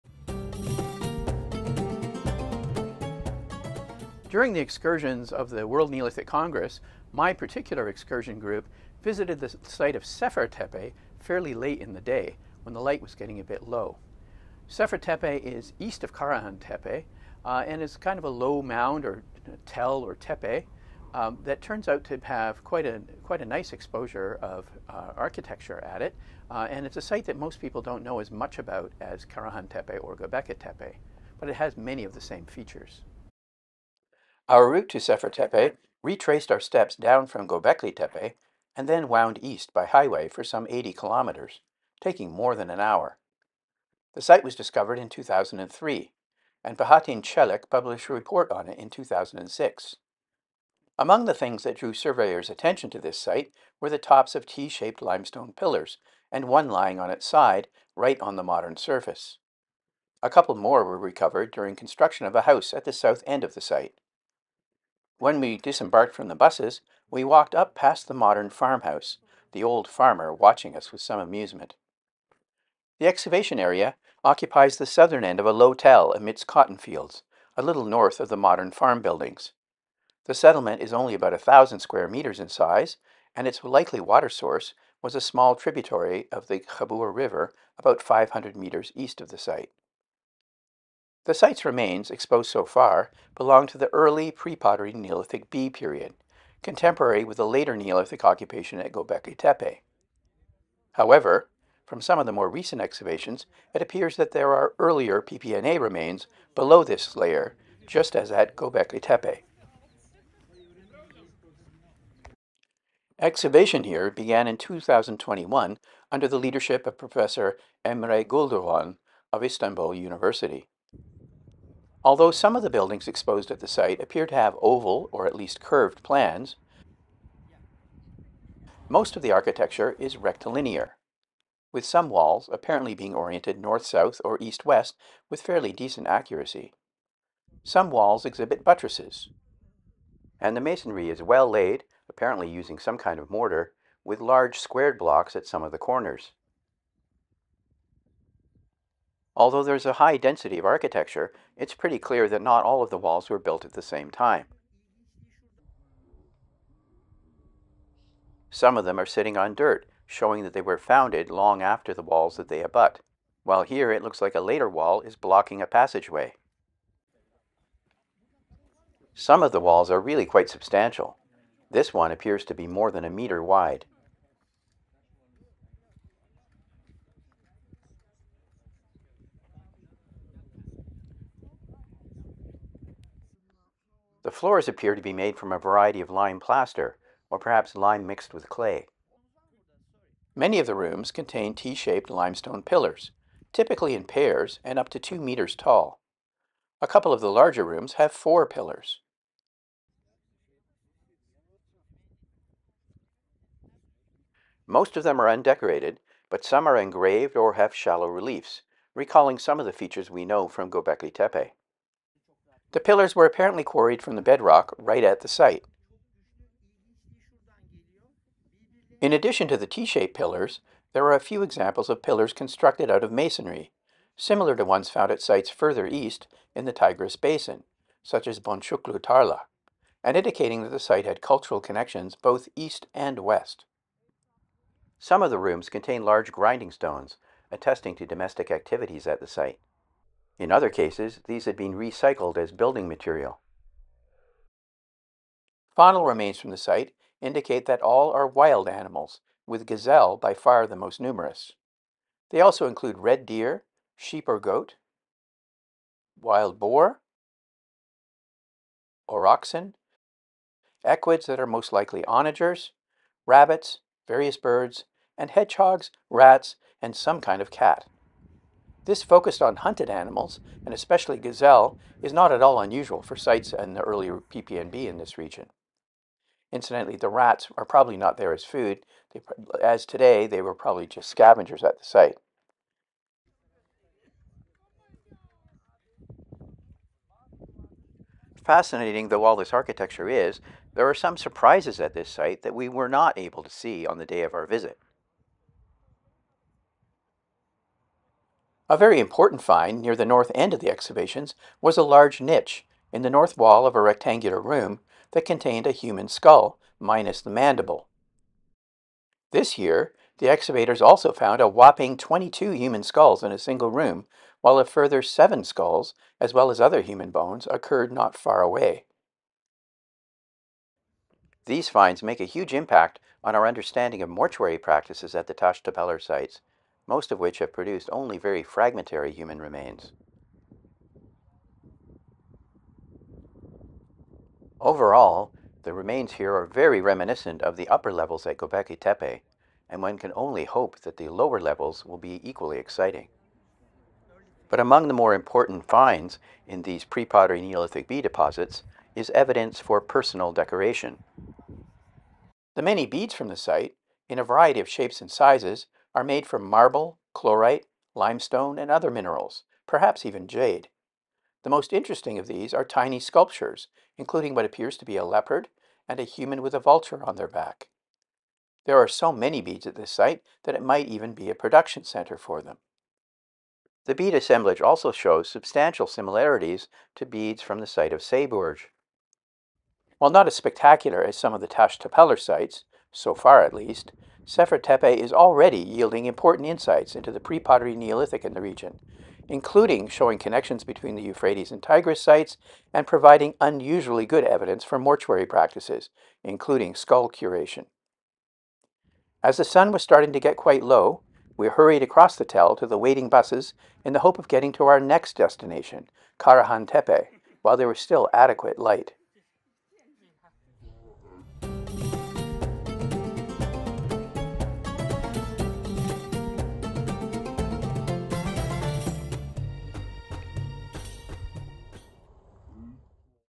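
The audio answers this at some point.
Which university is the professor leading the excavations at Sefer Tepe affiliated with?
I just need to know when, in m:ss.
1:59.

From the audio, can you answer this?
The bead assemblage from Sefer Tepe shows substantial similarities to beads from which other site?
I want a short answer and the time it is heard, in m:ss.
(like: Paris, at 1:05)
Sayburç, at 6:18.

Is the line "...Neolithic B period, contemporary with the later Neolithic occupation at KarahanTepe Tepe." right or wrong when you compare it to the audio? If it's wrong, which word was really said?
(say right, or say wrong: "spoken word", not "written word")
wrong: "Göbekli", not "KarahanTepe".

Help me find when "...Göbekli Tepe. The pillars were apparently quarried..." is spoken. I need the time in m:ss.
3:30.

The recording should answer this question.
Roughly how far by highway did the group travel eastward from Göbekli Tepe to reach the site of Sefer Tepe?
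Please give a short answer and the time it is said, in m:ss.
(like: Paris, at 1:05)
80 kilometers, at 0:40.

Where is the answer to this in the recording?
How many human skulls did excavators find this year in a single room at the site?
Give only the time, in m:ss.
5:11.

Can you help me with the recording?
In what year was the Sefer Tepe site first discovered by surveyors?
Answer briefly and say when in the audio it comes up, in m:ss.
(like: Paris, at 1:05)
2003, at 0:45.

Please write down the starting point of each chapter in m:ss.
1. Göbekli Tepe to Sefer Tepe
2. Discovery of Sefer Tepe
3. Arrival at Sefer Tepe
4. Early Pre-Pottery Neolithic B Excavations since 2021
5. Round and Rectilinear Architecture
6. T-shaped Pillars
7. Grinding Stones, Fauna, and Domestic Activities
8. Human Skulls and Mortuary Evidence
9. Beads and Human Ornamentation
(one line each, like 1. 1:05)
1. 0:33
2. 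0:43
3. 1:04
4. 1:30
5. 2:00
6. 3:09
7. 3:54
8. 4:55
9. 5:44.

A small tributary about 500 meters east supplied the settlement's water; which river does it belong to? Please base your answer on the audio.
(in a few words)
Khabur River.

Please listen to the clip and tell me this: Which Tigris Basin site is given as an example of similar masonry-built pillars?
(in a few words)
Boncuklu Tarla.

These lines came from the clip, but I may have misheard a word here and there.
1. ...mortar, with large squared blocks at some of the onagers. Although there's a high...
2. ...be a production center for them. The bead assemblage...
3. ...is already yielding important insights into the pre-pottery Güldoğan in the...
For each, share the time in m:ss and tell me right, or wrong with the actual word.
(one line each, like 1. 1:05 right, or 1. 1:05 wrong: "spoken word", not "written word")
1. 2:23 wrong: "corners", not "onagers"
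2. 6:11 right
3. 6:24 wrong: "Neolithic", not "Güldoğan".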